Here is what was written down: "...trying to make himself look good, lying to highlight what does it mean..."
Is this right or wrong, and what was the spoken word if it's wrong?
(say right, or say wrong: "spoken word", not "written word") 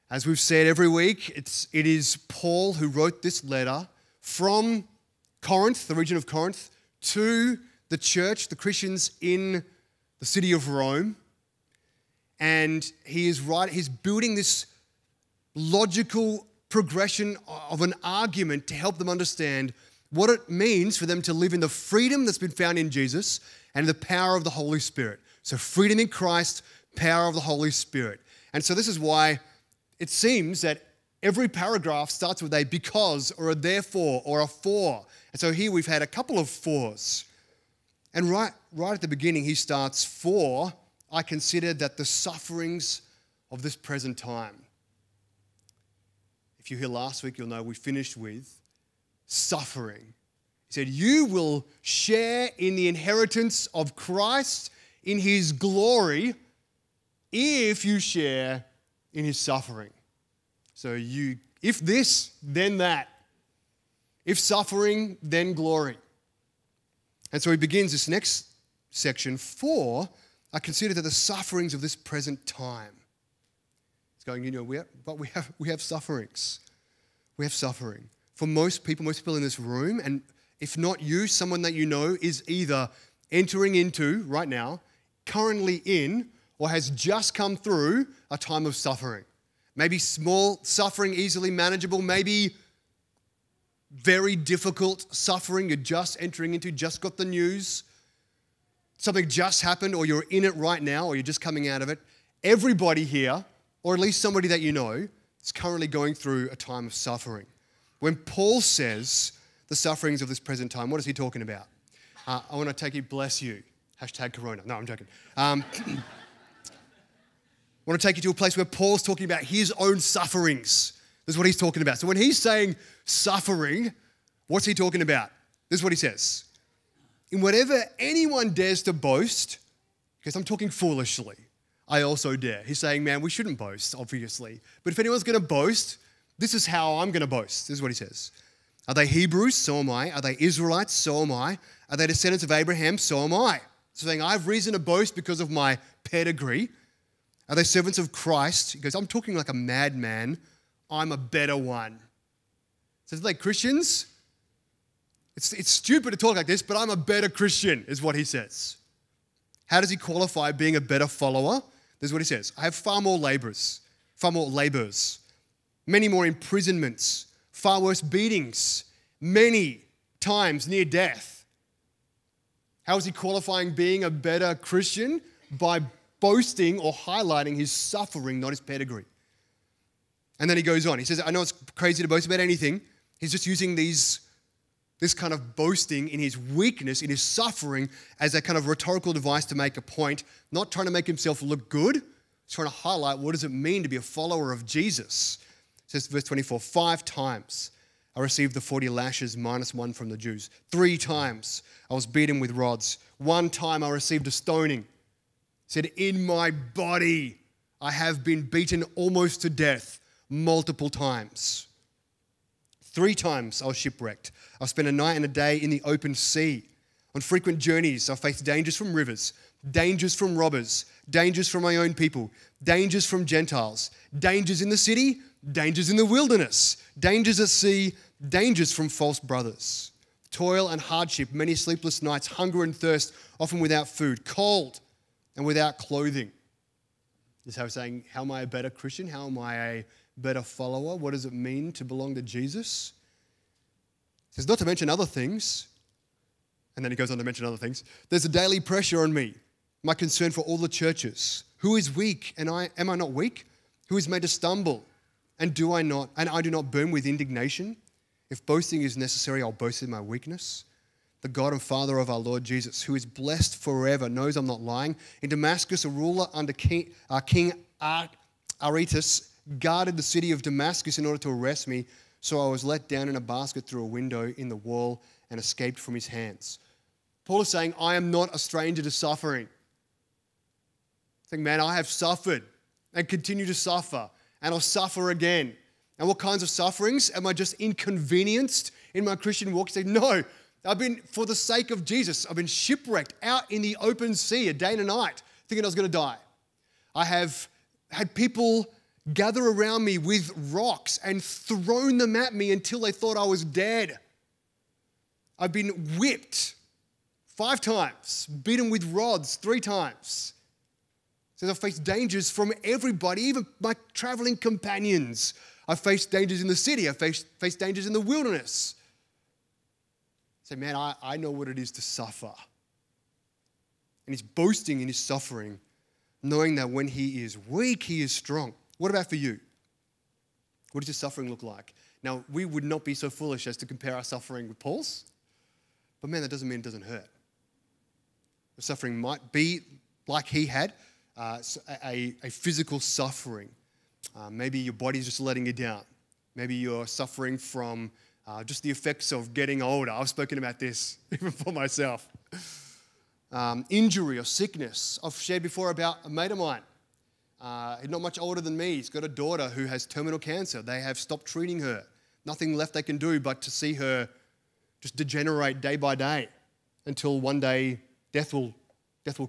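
wrong: "trying", not "lying".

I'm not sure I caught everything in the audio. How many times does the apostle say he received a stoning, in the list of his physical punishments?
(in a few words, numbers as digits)
1.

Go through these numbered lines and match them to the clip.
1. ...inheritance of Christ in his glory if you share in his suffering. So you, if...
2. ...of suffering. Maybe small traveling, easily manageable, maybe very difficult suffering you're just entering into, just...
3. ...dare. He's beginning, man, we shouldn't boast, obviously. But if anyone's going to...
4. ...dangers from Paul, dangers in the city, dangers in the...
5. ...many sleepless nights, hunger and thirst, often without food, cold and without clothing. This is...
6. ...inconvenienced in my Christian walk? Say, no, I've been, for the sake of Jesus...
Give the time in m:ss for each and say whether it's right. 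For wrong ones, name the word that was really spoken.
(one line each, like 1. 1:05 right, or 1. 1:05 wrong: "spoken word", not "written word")
1. 0:52 right
2. 1:28 wrong: "suffering", not "traveling"
3. 2:12 wrong: "saying", not "beginning"
4. 3:42 wrong: "Gentiles", not "Paul"
5. 3:51 right
6. 4:47 right.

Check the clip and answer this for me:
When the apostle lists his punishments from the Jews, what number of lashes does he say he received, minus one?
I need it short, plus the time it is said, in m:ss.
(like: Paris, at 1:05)
40, at 3:18.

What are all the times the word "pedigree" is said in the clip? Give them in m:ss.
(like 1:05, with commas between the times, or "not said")
2:26, 2:58.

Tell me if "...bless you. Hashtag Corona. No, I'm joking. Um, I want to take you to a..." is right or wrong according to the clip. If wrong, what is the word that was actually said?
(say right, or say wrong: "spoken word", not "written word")
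right.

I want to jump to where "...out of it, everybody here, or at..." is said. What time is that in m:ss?
1:41.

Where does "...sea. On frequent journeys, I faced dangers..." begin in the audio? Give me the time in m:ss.
3:36.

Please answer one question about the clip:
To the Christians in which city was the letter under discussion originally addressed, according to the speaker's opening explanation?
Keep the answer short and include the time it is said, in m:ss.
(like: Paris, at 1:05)
Rome, at 0:10.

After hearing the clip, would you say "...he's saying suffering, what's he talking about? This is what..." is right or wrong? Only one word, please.
right.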